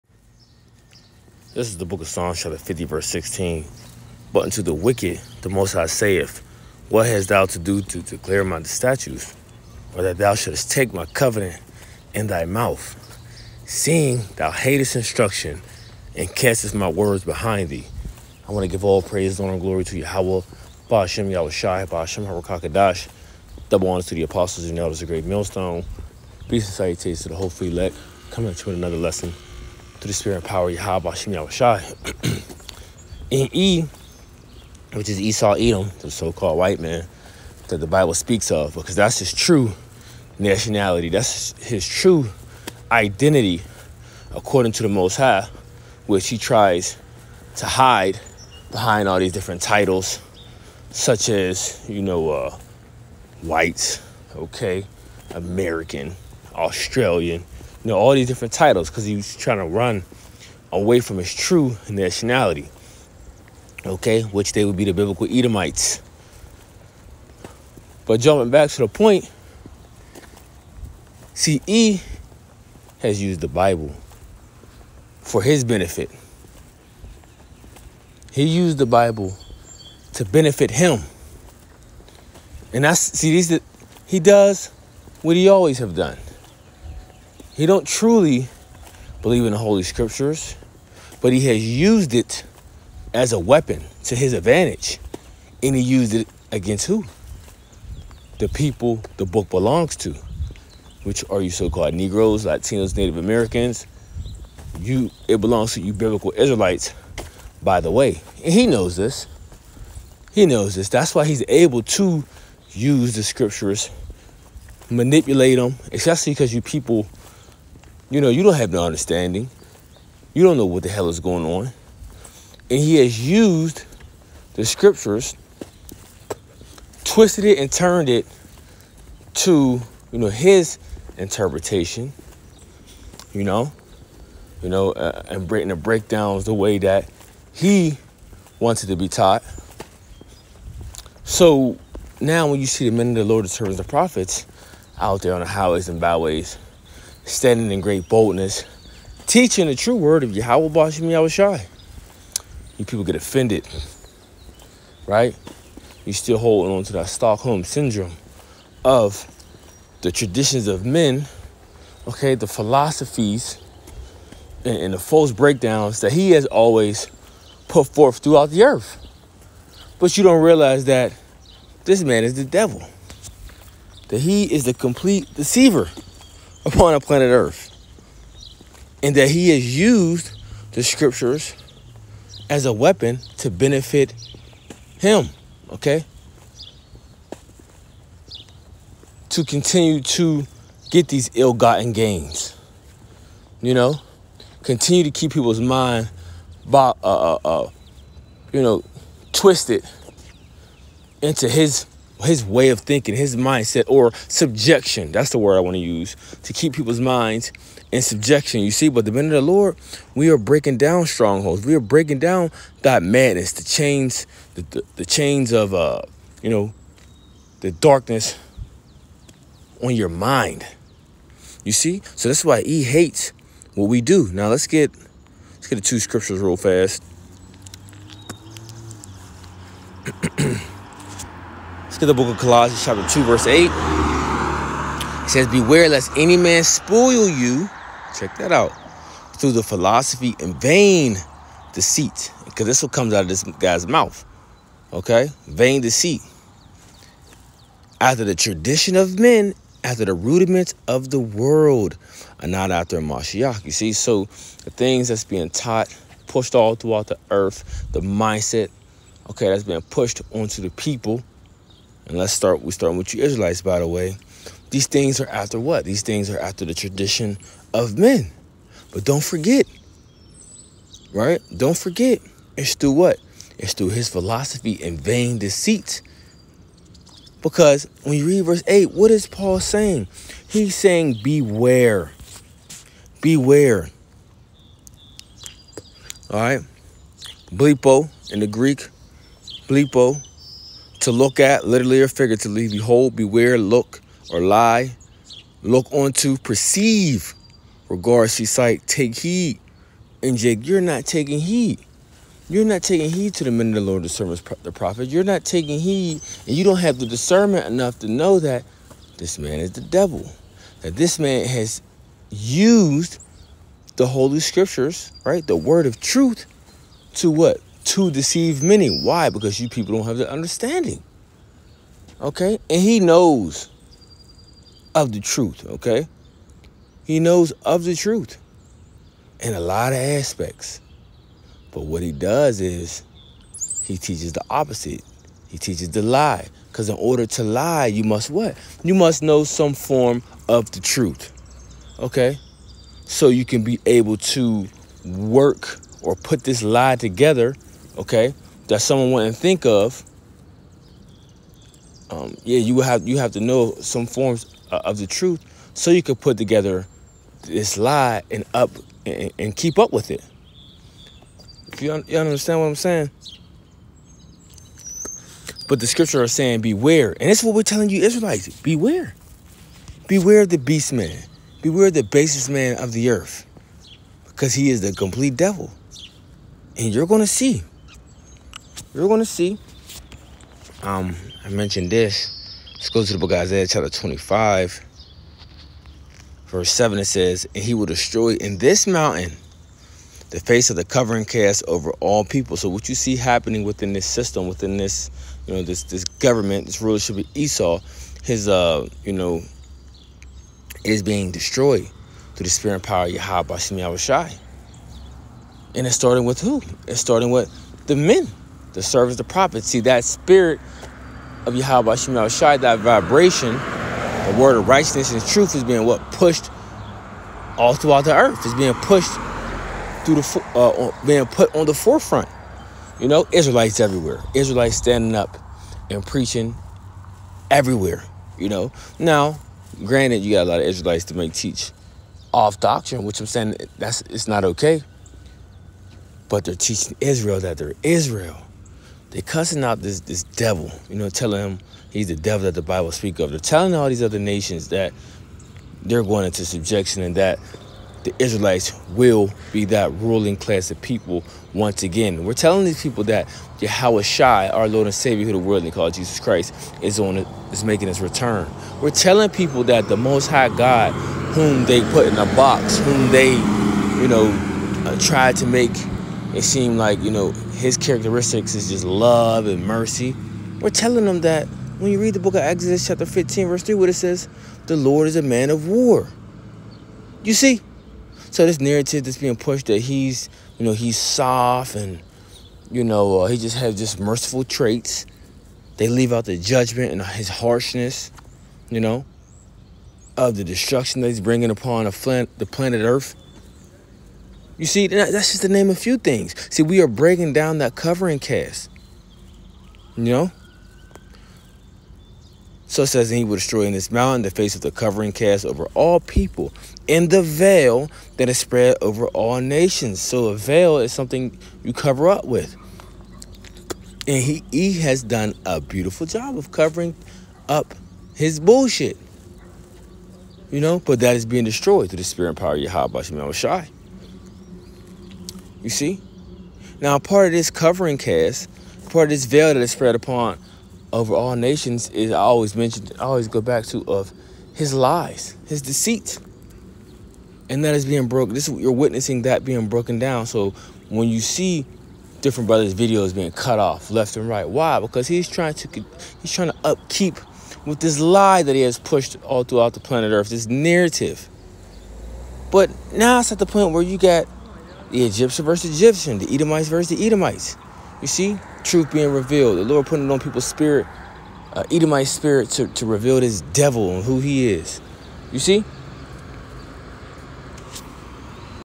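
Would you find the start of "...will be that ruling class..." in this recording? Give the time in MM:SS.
07:28.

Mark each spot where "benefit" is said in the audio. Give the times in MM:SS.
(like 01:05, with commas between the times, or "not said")
01:15, 01:20, 03:03.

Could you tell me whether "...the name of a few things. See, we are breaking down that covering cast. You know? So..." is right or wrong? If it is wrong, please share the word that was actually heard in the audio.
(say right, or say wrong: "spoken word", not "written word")
right.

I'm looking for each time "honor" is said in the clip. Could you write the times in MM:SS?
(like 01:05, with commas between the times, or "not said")
00:19, 00:23.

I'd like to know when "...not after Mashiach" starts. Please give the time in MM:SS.
04:12.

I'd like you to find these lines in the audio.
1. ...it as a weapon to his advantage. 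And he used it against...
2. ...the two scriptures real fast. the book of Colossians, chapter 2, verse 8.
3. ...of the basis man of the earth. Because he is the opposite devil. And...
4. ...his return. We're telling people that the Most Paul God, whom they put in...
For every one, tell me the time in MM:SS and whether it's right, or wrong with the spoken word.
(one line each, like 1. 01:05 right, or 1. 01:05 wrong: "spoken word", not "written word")
1. 01:32 right
2. 03:45 right
3. 06:11 wrong: "complete", not "opposite"
4. 07:37 wrong: "High", not "Paul".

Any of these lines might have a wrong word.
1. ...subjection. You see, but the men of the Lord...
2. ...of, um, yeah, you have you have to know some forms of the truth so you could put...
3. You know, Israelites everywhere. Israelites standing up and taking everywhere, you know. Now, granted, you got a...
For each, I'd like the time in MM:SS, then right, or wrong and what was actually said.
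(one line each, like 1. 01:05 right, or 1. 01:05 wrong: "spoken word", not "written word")
1. 03:28 right
2. 05:49 right
3. 07:02 wrong: "preaching", not "taking".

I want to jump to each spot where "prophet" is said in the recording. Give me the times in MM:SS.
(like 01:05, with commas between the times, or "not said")
02:23, 05:04, 06:49.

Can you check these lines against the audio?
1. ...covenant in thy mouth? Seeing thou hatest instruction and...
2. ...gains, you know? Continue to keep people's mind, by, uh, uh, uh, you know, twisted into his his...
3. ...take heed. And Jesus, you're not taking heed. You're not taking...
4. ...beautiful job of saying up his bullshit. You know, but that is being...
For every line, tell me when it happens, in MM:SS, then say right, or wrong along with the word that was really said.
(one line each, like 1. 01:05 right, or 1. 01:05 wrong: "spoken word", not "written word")
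1. 00:11 right
2. 03:11 right
3. 04:58 wrong: "Jake", not "Jesus"
4. 08:35 wrong: "covering", not "saying".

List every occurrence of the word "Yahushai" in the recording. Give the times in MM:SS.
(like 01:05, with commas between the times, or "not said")
00:21, 00:31, 02:31.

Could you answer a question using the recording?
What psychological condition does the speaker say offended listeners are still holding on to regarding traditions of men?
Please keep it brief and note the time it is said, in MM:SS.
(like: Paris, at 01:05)
Stockholm syndrome, at 02:37.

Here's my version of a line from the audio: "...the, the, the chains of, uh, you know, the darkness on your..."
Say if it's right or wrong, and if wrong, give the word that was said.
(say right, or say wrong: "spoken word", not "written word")
right.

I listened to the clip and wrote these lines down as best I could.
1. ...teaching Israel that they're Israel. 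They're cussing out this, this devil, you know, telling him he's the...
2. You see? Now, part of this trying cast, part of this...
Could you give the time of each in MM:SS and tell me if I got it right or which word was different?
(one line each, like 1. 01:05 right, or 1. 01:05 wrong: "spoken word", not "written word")
1. 07:16 right
2. 08:45 wrong: "covering", not "trying".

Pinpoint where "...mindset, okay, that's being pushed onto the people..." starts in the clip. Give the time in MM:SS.
04:17.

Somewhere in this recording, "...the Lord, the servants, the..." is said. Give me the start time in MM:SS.
02:23.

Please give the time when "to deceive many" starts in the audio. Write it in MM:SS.
05:17.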